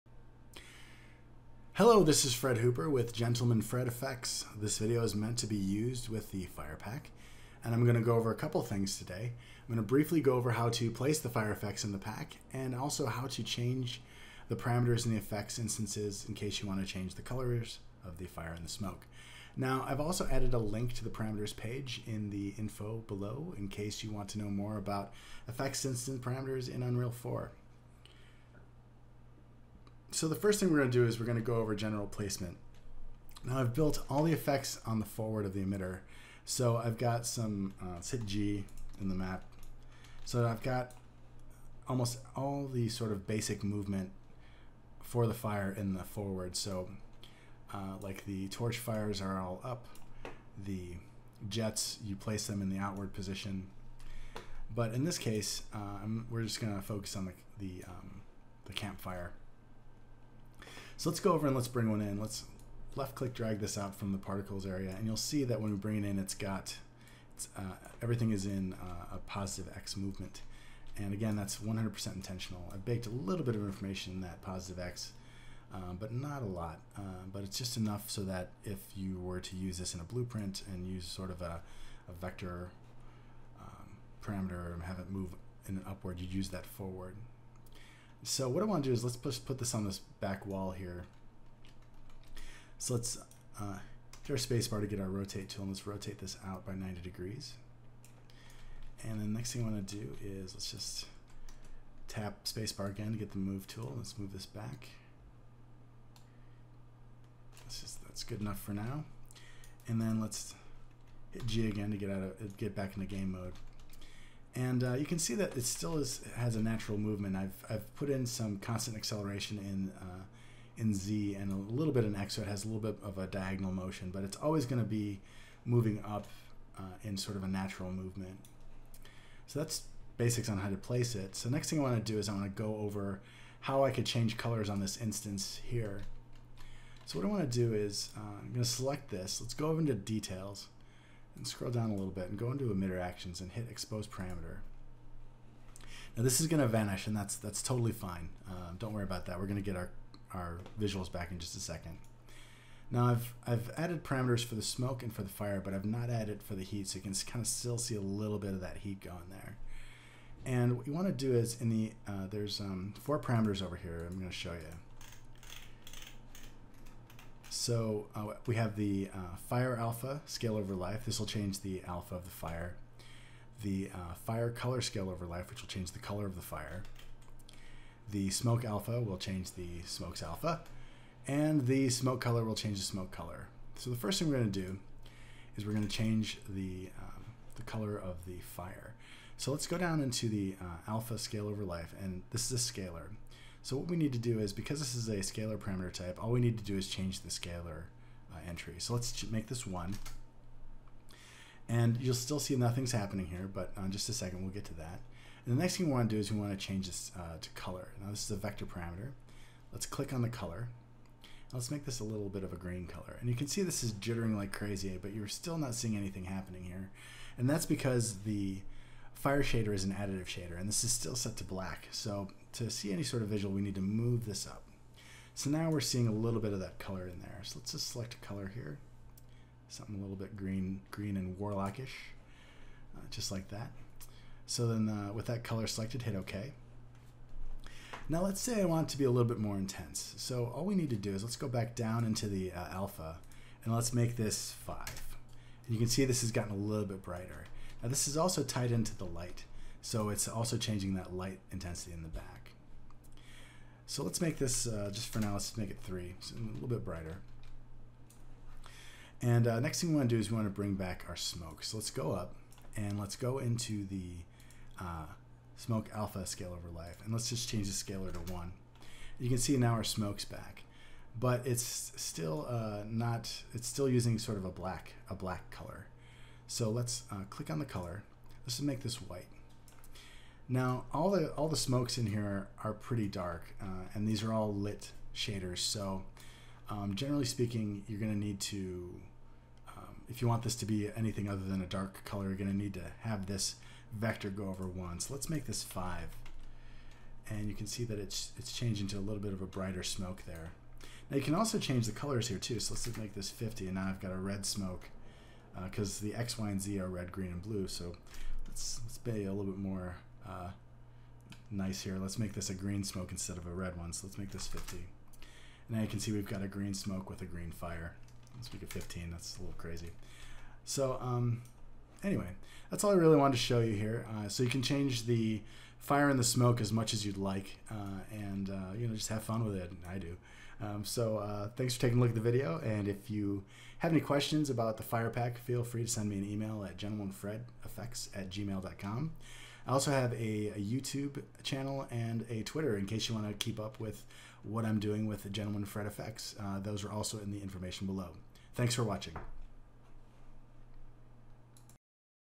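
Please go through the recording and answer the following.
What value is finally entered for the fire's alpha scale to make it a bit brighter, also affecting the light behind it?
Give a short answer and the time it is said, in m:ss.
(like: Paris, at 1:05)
3, at 4:15.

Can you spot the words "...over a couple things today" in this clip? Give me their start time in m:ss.
0:08.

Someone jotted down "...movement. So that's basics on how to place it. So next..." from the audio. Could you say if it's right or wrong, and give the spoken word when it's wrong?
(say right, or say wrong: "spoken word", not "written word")
right.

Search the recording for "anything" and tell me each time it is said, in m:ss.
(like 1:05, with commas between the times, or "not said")
3:35, 4:50.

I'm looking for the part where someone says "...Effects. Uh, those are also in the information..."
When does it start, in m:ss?
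5:45.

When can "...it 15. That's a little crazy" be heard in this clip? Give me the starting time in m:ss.
5:18.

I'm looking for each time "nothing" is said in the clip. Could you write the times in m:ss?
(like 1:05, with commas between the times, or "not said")
3:22.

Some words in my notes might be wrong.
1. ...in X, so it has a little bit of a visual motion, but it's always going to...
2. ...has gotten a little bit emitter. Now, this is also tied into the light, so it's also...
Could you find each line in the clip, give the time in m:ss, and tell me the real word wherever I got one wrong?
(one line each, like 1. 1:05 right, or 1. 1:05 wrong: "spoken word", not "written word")
1. 2:02 wrong: "diagonal", not "visual"
2. 4:06 wrong: "brighter", not "emitter".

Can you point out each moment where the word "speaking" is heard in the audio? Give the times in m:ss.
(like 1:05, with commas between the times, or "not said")
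4:47.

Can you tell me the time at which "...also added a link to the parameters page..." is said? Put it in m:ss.
0:19.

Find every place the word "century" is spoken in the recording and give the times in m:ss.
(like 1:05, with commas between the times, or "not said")
not said.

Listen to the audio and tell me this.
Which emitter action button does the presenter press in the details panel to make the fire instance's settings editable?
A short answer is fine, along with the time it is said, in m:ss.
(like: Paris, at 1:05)
expose parameter, at 2:23.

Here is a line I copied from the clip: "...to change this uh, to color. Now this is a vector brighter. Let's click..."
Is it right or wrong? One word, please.
wrong.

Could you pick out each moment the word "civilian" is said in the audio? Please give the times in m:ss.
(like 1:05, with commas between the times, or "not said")
not said.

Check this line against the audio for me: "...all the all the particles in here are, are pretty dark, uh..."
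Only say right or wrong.
wrong.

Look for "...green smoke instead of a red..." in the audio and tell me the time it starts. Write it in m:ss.
5:12.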